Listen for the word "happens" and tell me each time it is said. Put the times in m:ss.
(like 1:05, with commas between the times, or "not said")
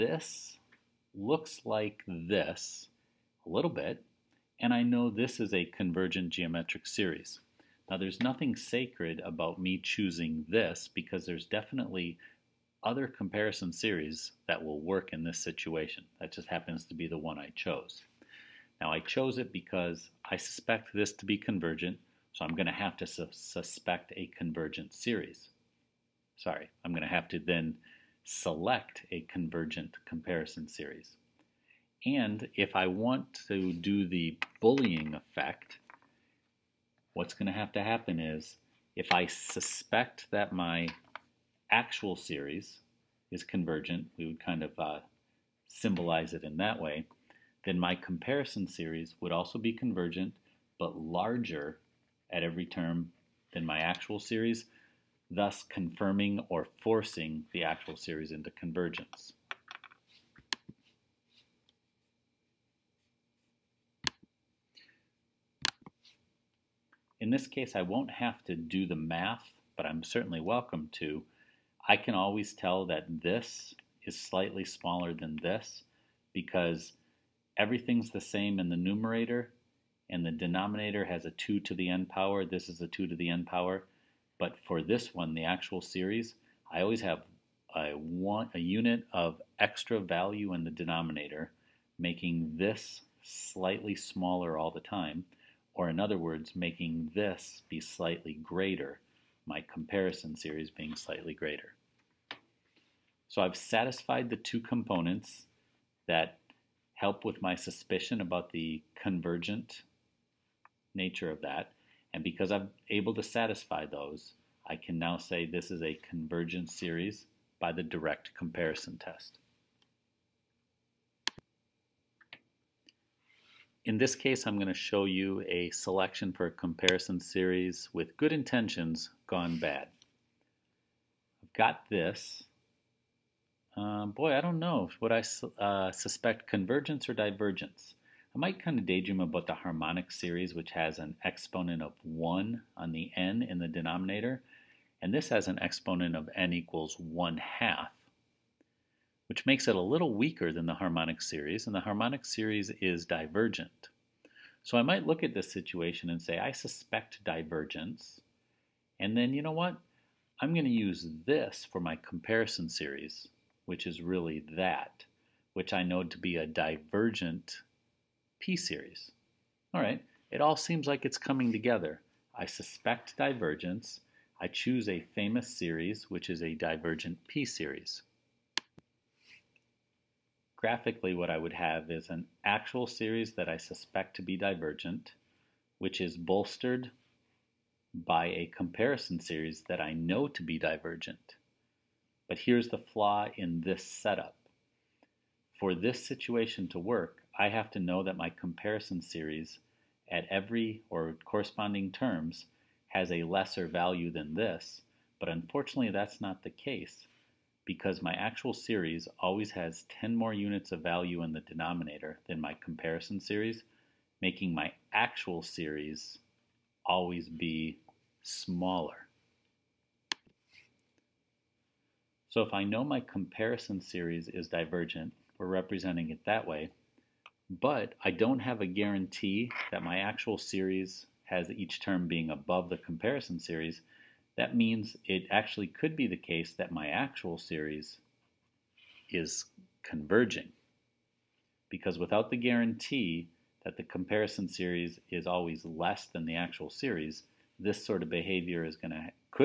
0:16, 0:37.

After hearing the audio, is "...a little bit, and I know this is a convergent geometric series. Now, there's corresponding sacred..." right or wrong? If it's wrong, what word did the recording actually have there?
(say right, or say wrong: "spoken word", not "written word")
wrong: "nothing", not "corresponding".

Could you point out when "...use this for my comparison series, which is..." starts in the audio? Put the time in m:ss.
2:40.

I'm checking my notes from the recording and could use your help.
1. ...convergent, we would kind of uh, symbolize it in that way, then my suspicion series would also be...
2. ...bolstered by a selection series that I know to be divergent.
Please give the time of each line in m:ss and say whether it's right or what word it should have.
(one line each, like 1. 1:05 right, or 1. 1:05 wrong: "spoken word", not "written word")
1. 0:43 wrong: "comparison", not "suspicion"
2. 3:06 wrong: "comparison", not "selection".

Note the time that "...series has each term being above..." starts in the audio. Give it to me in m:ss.
3:50.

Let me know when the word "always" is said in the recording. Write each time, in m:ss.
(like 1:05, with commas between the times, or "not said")
1:12, 1:26, 3:29, 3:36, 4:05.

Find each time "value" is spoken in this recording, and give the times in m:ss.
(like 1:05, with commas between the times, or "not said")
1:29, 3:23, 3:30.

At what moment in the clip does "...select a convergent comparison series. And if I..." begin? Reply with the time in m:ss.
0:28.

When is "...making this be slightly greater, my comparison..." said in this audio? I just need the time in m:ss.
1:36.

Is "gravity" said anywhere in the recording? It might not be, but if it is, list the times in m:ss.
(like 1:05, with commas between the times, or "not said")
not said.